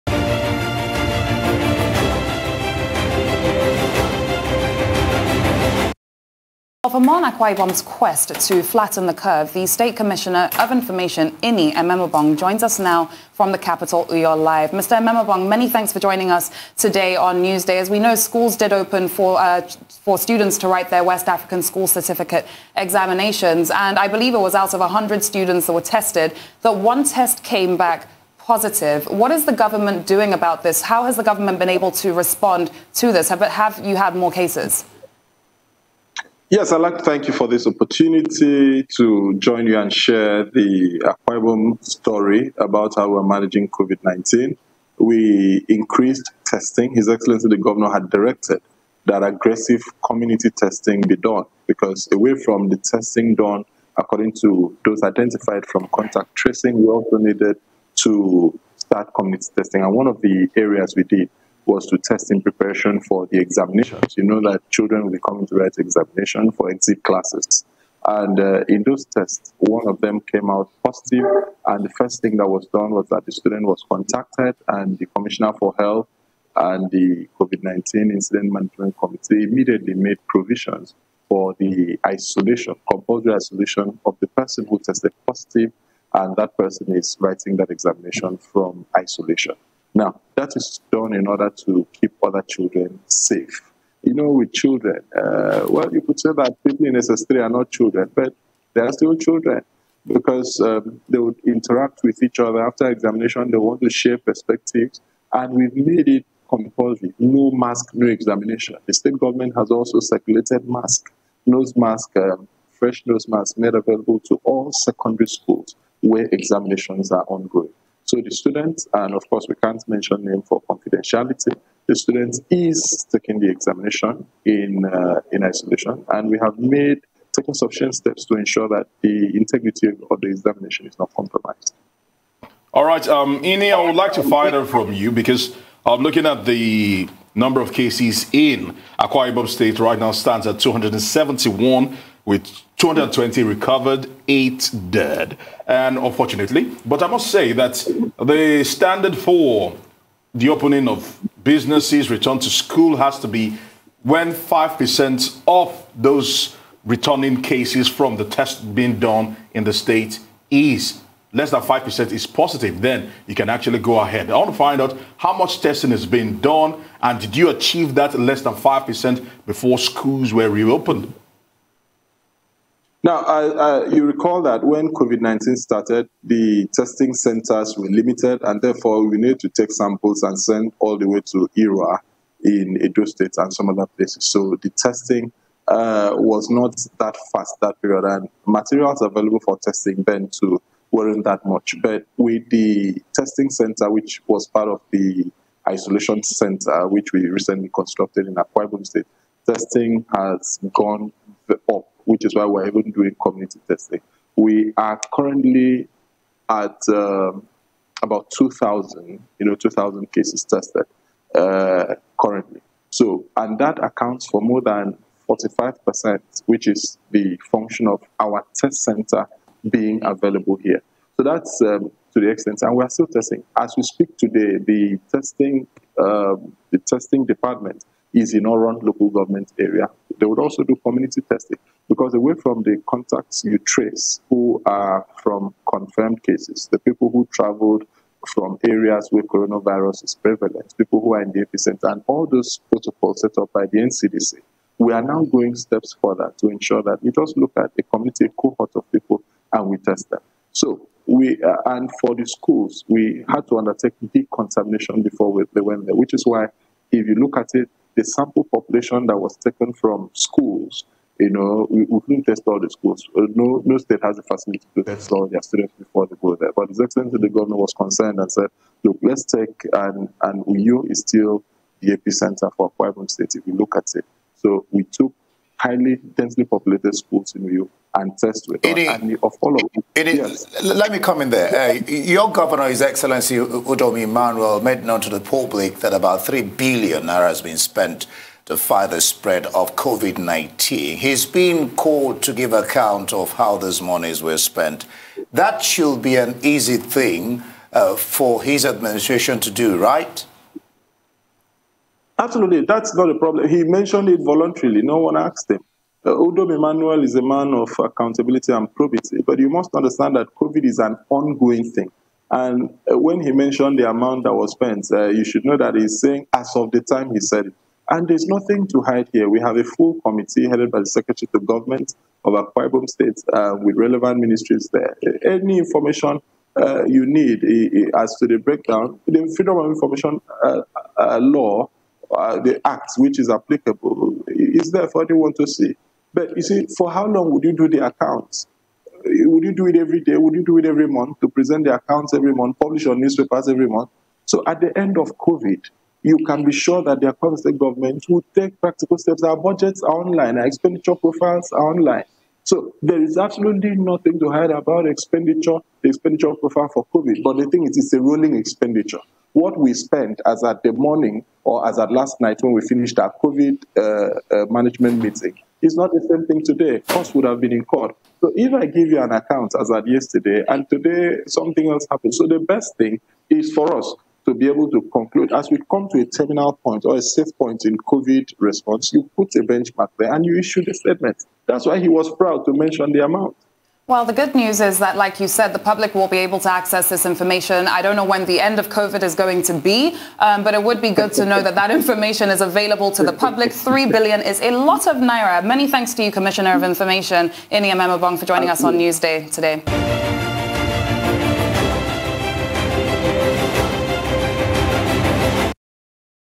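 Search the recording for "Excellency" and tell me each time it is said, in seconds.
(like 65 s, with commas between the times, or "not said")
47 s, 266 s, 282 s.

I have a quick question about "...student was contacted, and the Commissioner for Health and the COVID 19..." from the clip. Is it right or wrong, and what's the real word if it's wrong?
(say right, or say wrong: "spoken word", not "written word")
right.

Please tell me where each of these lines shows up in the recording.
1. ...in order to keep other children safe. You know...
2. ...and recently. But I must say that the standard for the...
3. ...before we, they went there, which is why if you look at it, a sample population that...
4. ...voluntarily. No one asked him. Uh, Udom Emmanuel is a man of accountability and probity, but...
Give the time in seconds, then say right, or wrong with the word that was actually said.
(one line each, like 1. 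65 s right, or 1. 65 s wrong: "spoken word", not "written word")
1. 91 s right
2. 145 s wrong: "unfortunately", not "recently"
3. 255 s right
4. 304 s right.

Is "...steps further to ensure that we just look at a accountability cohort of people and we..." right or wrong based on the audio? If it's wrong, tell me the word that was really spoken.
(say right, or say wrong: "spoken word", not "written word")
wrong: "community", not "accountability".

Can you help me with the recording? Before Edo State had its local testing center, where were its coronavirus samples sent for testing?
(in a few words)
Irrua.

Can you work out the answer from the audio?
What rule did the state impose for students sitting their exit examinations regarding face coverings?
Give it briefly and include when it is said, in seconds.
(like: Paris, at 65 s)
No mask, no examination, at 107 s.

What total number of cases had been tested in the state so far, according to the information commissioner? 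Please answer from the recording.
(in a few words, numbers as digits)
2,000.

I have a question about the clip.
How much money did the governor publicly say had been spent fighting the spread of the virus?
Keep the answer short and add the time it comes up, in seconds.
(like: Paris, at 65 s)
3 billion naira, at 286 s.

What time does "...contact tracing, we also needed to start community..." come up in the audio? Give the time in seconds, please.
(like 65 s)
55 s.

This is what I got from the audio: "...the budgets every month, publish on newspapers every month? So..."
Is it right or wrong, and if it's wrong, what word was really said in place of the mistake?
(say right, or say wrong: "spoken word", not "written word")
wrong: "accounts", not "budgets".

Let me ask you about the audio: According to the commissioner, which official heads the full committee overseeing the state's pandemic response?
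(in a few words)
Secretary of Government.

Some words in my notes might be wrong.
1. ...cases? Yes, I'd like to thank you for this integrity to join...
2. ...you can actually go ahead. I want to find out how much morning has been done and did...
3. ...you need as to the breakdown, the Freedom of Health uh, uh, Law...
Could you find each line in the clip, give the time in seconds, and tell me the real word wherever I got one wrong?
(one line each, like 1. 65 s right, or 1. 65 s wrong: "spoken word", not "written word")
1. 34 s wrong: "opportunity", not "integrity"
2. 163 s wrong: "testing", not "morning"
3. 326 s wrong: "Information", not "Health".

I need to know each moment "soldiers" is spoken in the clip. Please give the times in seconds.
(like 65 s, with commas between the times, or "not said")
not said.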